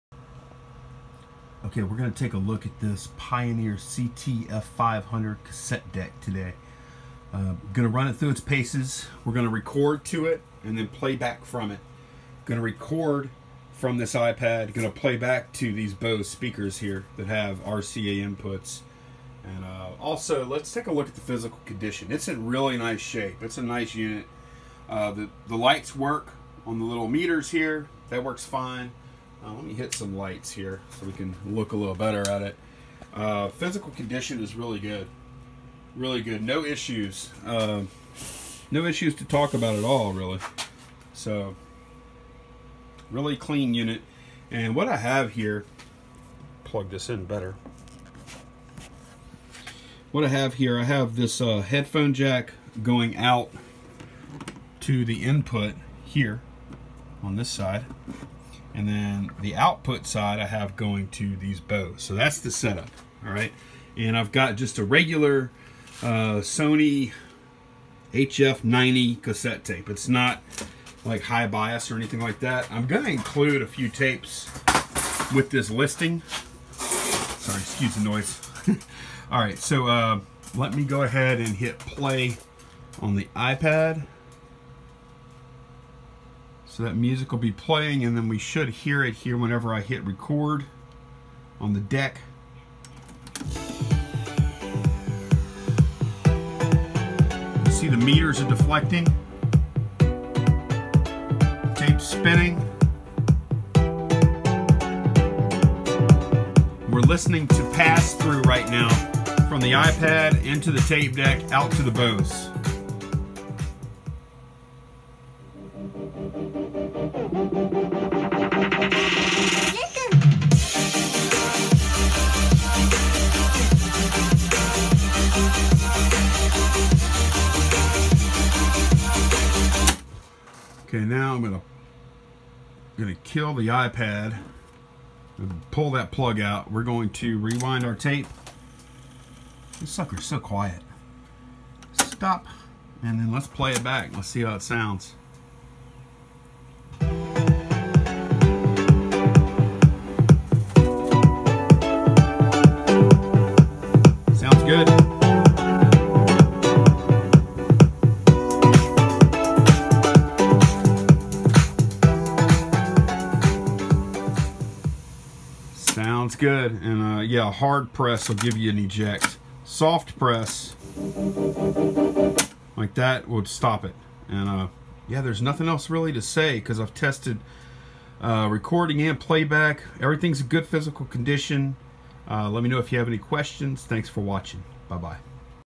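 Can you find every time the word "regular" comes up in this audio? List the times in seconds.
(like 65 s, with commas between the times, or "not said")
64 s.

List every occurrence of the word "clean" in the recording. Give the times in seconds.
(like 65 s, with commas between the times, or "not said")
43 s.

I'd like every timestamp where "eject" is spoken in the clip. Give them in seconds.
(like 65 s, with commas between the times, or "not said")
168 s.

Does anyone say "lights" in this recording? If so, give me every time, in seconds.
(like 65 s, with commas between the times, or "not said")
25 s, 30 s.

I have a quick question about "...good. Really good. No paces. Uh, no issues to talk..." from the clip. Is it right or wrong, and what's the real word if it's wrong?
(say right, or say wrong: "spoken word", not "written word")
wrong: "issues", not "paces".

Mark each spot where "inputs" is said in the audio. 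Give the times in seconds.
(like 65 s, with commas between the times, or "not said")
18 s, 55 s.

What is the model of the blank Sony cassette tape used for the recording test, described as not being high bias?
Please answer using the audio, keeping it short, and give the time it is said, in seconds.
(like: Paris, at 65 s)
HF90, at 68 s.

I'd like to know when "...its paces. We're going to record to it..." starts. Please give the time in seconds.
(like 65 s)
8 s.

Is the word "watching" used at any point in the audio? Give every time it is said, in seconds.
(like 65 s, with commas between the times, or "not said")
184 s.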